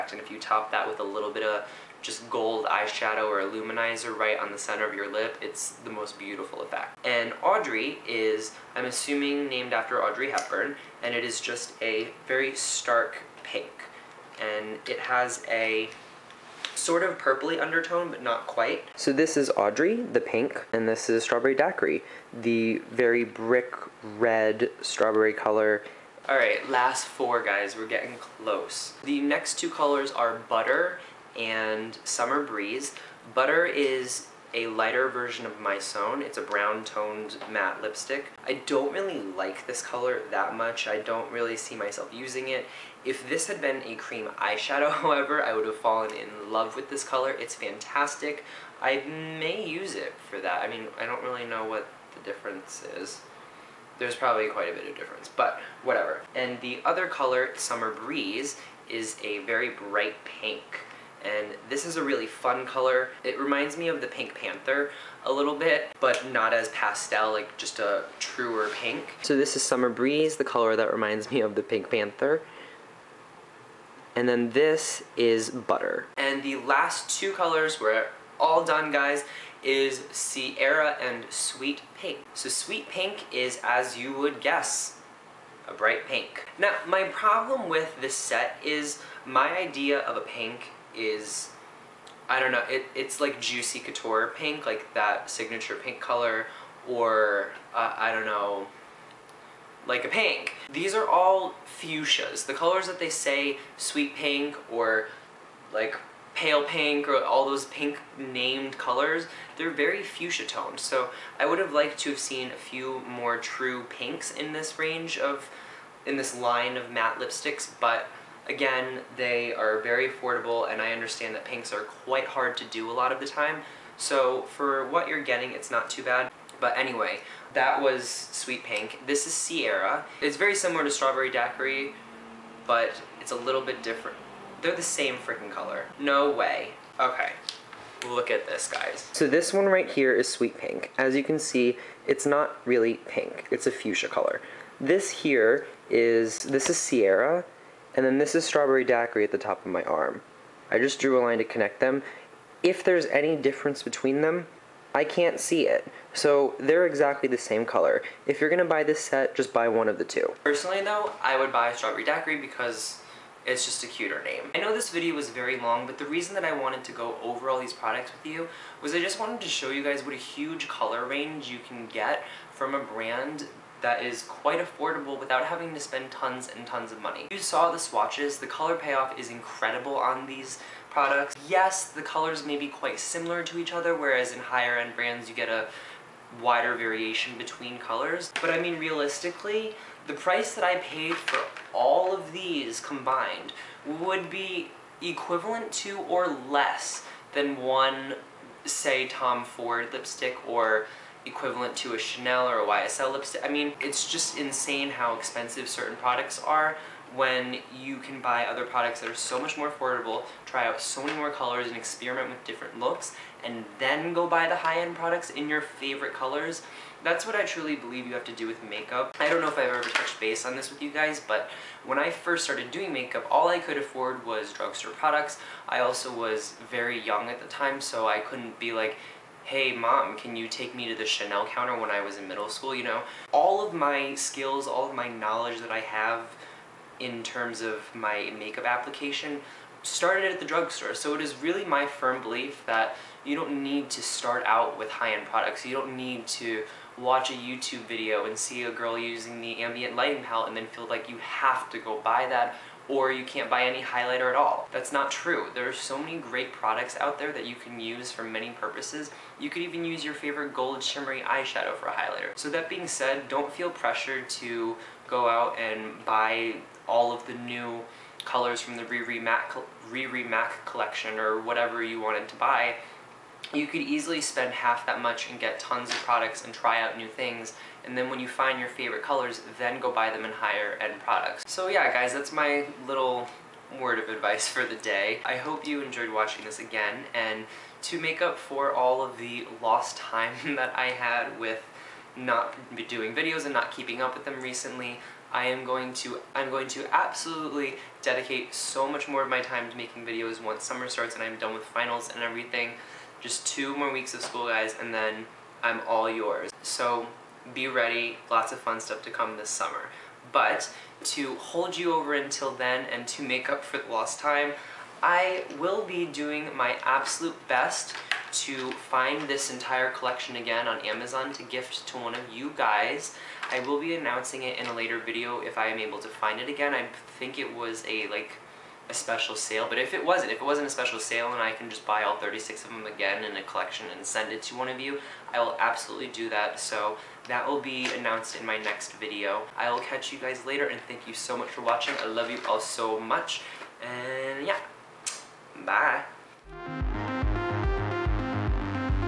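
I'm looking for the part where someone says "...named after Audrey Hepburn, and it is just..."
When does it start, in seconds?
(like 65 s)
9 s.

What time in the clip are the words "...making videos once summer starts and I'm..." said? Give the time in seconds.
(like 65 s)
299 s.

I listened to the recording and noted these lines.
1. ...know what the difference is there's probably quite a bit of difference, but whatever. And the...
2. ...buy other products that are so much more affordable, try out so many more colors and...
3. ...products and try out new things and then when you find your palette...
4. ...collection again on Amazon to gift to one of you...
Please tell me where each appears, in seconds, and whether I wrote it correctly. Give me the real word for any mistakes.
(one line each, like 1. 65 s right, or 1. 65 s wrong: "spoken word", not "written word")
1. 51 s right
2. 208 s right
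3. 275 s wrong: "favorite", not "palette"
4. 319 s right.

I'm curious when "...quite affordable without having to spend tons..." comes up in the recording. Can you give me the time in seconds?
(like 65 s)
174 s.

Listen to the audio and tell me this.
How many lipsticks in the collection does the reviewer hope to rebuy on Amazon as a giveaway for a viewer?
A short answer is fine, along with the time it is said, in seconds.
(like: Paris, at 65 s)
36, at 332 s.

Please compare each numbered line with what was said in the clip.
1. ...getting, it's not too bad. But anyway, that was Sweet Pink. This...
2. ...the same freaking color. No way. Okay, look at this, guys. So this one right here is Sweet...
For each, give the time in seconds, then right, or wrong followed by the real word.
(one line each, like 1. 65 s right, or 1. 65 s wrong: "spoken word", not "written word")
1. 125 s right
2. 134 s right.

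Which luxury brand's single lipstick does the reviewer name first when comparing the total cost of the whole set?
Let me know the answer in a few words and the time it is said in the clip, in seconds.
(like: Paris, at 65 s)
Tom Ford, at 199 s.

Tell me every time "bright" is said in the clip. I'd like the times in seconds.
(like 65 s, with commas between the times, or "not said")
59 s, 85 s.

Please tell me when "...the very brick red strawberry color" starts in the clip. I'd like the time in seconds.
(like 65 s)
22 s.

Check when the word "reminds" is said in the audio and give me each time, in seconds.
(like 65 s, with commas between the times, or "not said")
63 s, 70 s.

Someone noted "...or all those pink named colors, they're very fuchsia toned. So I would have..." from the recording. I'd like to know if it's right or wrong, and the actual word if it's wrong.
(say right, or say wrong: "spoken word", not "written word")
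right.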